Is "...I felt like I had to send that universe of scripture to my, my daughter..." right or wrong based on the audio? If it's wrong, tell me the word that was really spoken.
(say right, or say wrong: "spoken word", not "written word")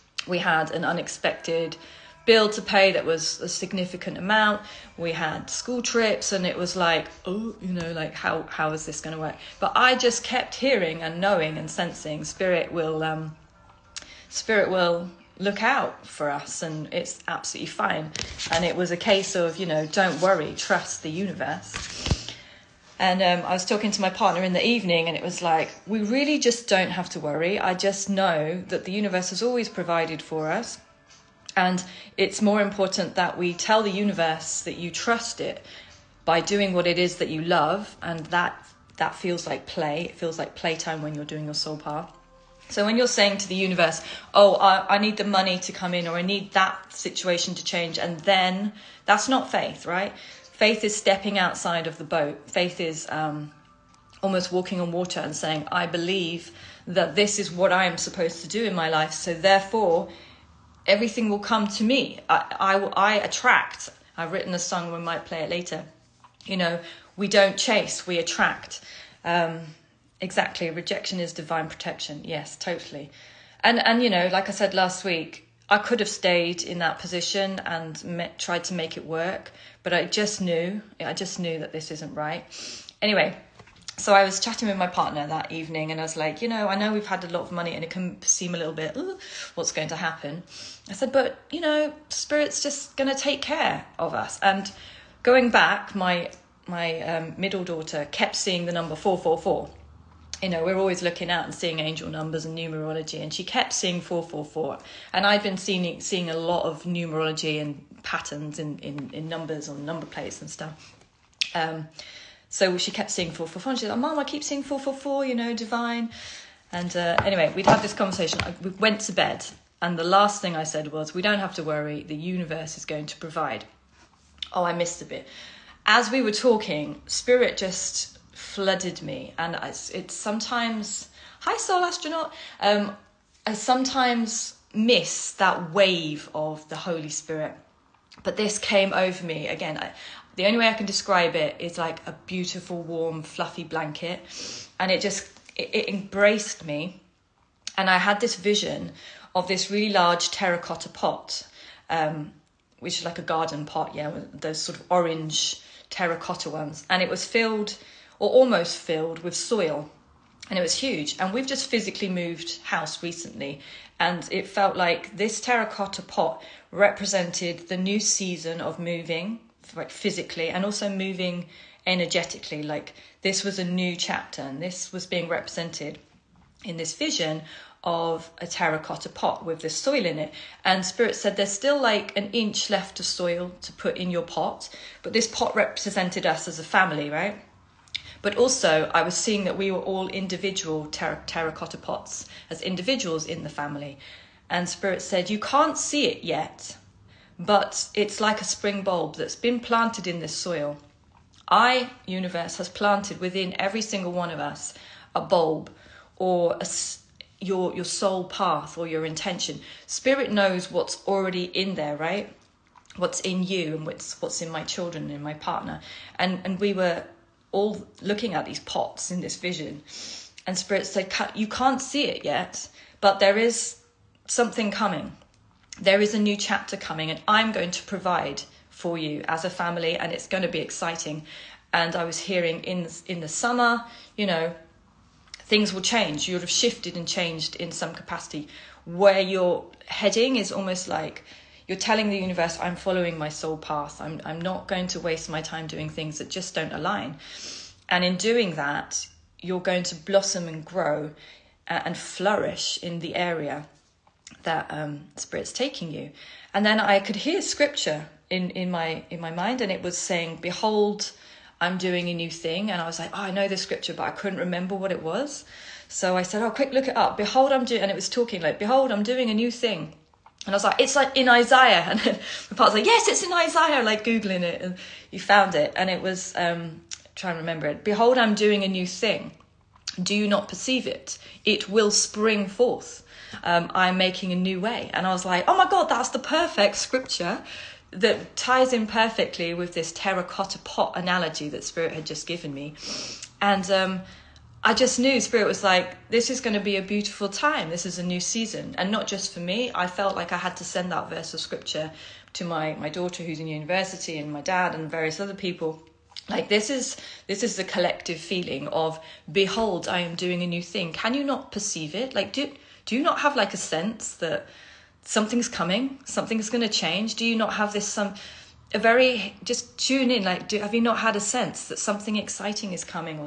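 wrong: "verse", not "universe".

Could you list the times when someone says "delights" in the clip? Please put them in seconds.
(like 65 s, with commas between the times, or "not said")
not said.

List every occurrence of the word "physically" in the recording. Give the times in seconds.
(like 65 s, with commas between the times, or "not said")
161 s, 169 s.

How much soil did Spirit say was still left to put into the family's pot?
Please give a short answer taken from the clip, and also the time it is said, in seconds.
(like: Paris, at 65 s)
An inch, at 182 s.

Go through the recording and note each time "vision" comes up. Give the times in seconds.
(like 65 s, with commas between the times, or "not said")
148 s, 176 s, 219 s.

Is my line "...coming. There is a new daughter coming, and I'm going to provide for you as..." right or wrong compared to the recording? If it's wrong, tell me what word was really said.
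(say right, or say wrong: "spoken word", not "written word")
wrong: "chapter", not "daughter".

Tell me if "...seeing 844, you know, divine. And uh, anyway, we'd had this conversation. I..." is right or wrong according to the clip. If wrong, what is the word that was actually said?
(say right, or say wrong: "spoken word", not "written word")
wrong: "444", not "844".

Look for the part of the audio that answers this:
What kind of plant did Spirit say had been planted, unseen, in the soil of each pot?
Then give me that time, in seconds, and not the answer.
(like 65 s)
198 s.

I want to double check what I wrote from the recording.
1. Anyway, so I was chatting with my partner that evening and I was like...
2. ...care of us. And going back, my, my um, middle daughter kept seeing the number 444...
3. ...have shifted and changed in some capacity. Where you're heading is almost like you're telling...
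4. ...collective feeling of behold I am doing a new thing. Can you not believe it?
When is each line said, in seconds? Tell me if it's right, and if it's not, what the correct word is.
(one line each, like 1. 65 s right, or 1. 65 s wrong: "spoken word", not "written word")
1. 83 s right
2. 93 s right
3. 236 s right
4. 307 s wrong: "perceive", not "believe".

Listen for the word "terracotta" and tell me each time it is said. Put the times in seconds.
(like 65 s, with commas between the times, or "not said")
150 s, 155 s, 165 s, 178 s, 191 s, 289 s.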